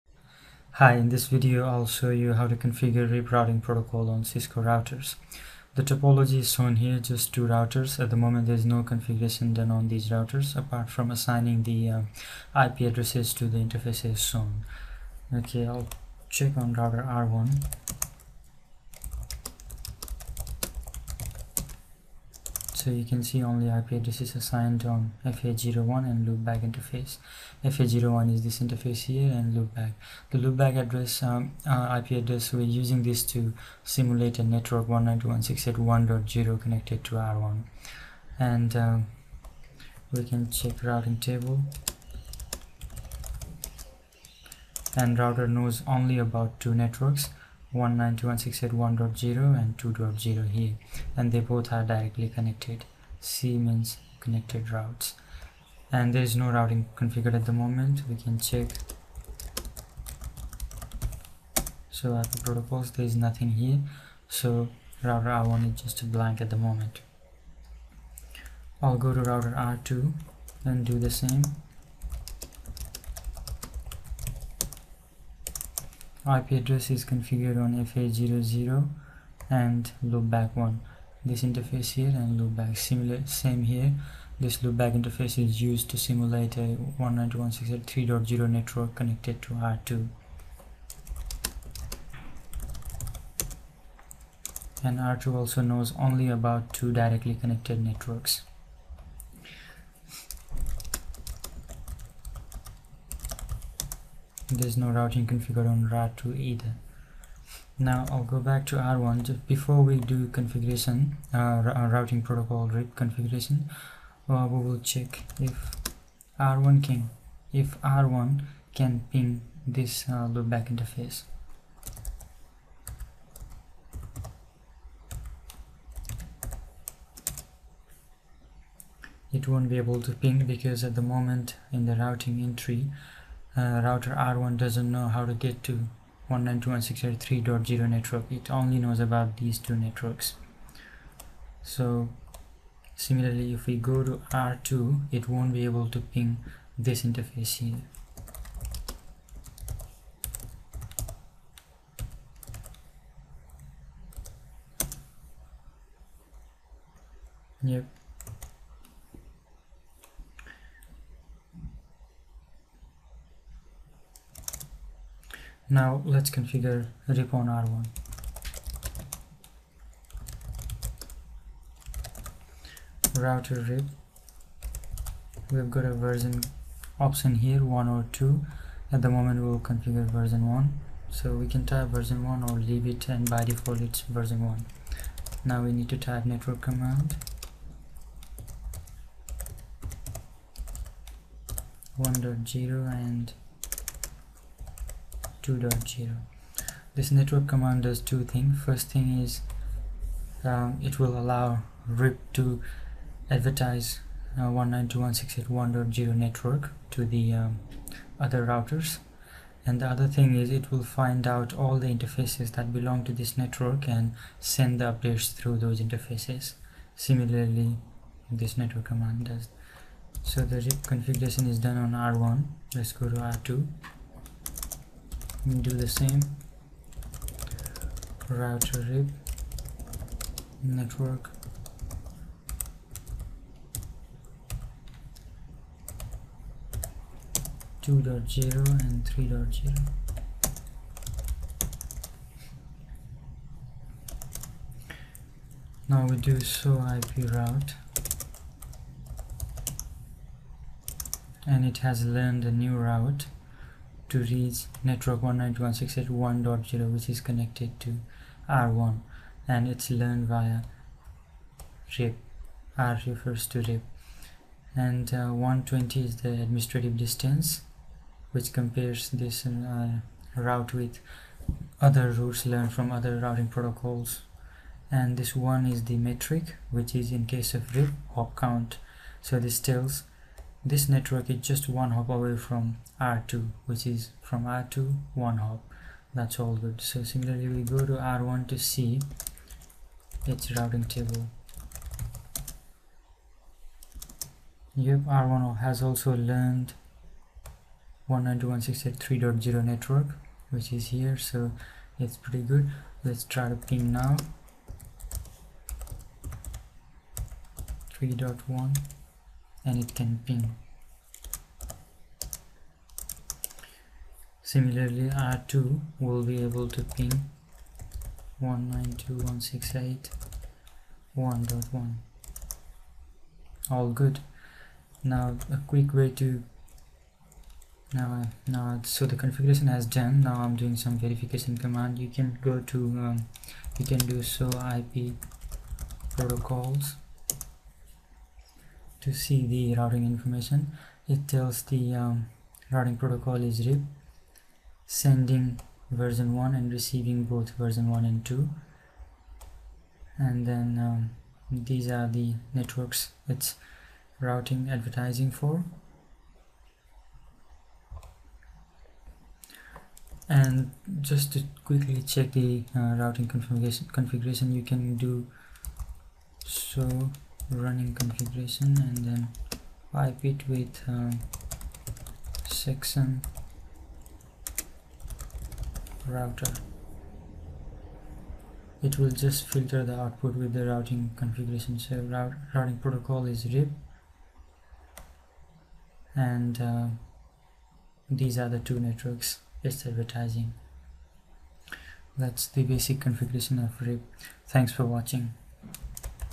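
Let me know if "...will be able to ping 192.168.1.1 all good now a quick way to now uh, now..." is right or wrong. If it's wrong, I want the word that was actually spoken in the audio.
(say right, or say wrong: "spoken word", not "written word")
right.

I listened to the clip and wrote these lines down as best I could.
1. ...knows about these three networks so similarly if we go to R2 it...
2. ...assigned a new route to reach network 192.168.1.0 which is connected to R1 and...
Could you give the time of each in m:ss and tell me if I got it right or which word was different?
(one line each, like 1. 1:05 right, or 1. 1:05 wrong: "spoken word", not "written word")
1. 2:18 wrong: "two", not "three"
2. 4:12 wrong: "learned", not "assigned".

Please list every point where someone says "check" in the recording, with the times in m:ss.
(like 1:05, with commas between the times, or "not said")
0:16, 0:40, 0:58, 1:54, 6:02.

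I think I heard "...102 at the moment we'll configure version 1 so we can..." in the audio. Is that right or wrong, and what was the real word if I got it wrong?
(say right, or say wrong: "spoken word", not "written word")
right.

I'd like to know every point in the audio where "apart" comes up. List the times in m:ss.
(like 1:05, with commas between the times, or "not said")
0:10.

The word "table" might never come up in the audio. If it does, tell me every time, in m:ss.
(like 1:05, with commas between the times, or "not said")
0:41, 4:50.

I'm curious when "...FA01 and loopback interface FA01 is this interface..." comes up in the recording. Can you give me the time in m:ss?
0:25.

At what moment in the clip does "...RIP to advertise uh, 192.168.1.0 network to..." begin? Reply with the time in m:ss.
3:21.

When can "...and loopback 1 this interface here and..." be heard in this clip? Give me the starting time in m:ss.
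1:19.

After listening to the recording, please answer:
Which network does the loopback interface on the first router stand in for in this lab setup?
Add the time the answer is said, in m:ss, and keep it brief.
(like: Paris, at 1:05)
192.168.1.0, at 0:34.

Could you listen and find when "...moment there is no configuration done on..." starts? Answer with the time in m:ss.
0:08.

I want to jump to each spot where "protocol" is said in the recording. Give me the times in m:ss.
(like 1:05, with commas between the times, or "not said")
0:03, 1:02, 1:52, 4:33, 5:36, 5:42, 6:22.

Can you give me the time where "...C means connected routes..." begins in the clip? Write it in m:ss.
0:53.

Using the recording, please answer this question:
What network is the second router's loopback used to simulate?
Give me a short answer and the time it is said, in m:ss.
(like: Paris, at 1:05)
192.168.3.0, at 1:26.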